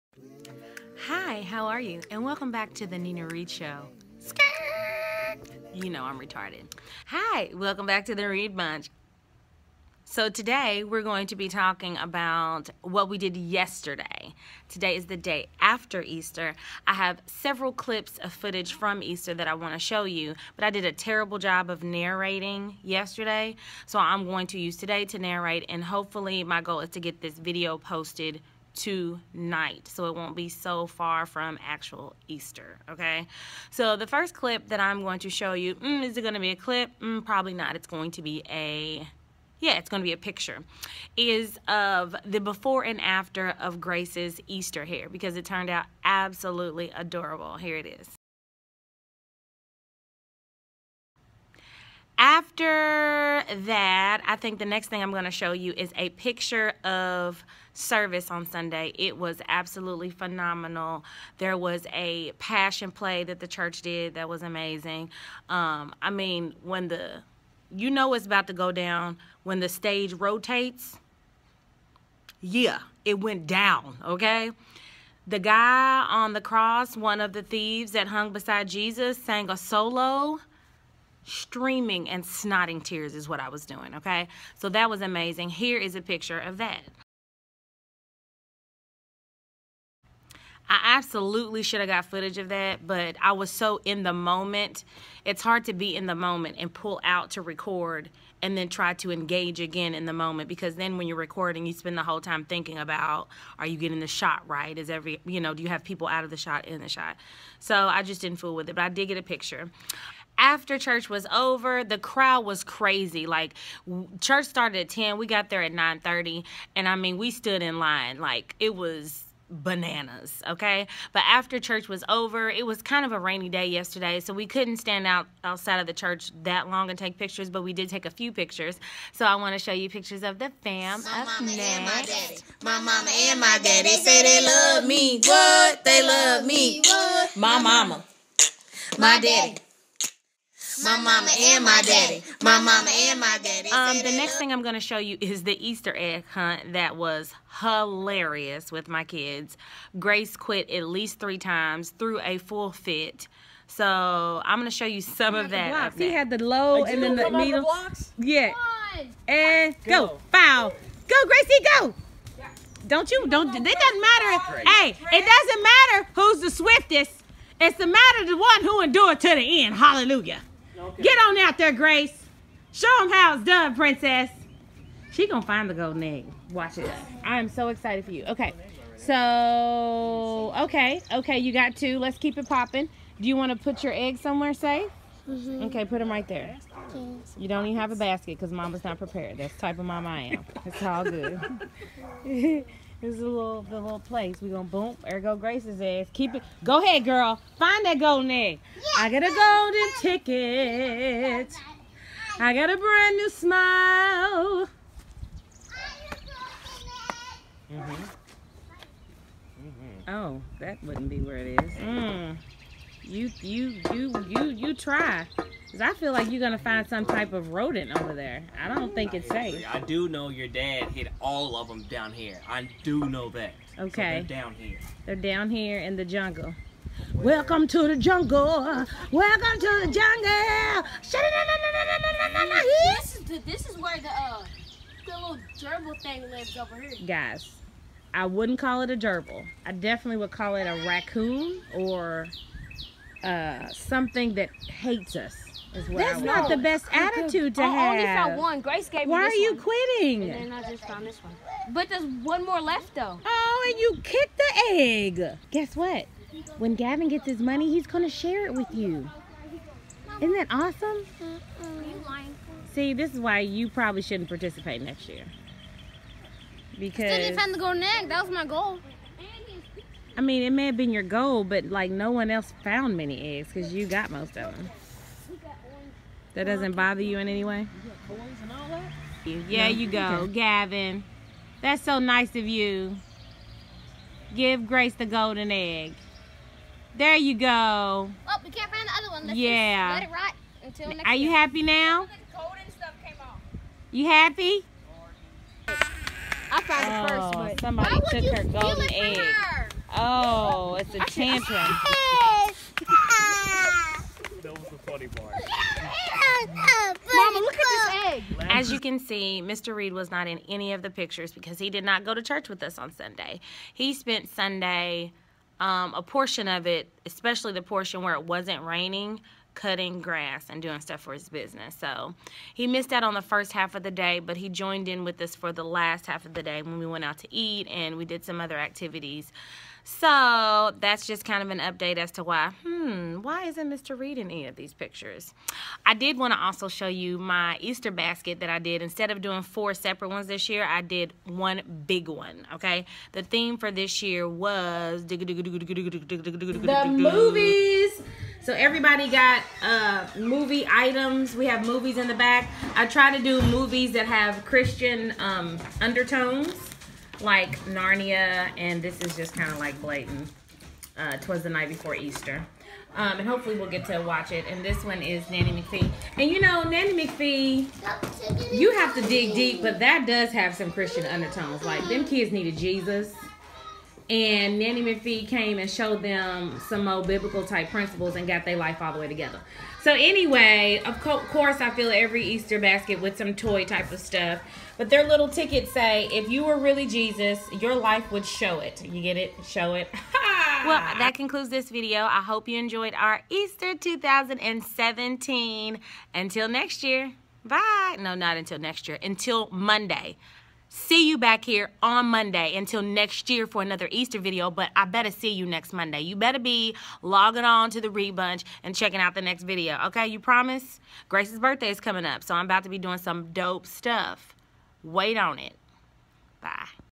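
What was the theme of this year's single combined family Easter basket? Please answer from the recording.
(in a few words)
The movies.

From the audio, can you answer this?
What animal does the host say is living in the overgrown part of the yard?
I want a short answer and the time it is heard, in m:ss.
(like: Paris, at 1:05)
Raccoon, at 4:00.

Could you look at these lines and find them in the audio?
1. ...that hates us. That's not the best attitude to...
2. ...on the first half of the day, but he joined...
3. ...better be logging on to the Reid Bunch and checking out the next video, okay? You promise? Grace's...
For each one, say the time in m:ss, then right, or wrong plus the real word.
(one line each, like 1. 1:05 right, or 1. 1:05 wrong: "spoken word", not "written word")
1. 4:04 right
2. 5:23 right
3. 6:46 right.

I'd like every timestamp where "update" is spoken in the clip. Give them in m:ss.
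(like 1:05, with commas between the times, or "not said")
5:31.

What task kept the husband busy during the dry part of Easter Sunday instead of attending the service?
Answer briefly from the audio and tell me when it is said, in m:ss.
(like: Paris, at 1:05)
Cutting grass, at 5:19.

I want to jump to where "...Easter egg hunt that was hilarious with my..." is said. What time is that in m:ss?
2:25.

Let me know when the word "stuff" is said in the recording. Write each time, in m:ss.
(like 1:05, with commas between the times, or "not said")
5:20, 6:24, 6:53.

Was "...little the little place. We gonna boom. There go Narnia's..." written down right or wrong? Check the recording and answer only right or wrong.
wrong.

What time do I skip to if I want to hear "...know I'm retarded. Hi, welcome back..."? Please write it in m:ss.
0:05.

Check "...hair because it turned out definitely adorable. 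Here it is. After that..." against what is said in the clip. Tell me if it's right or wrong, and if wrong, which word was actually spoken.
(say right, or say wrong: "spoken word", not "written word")
wrong: "absolutely", not "definitely".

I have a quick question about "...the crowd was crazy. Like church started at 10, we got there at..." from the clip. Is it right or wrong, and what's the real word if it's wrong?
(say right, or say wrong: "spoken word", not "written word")
right.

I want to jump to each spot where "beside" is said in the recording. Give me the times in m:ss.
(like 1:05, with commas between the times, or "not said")
1:18.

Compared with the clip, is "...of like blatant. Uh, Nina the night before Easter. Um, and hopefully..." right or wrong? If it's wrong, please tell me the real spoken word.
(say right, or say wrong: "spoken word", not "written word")
wrong: "Twas", not "Nina".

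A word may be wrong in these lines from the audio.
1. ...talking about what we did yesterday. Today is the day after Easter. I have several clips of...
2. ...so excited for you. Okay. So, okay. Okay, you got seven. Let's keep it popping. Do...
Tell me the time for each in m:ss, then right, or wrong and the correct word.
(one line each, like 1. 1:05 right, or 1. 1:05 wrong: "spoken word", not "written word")
1. 0:11 right
2. 2:57 wrong: "two", not "seven".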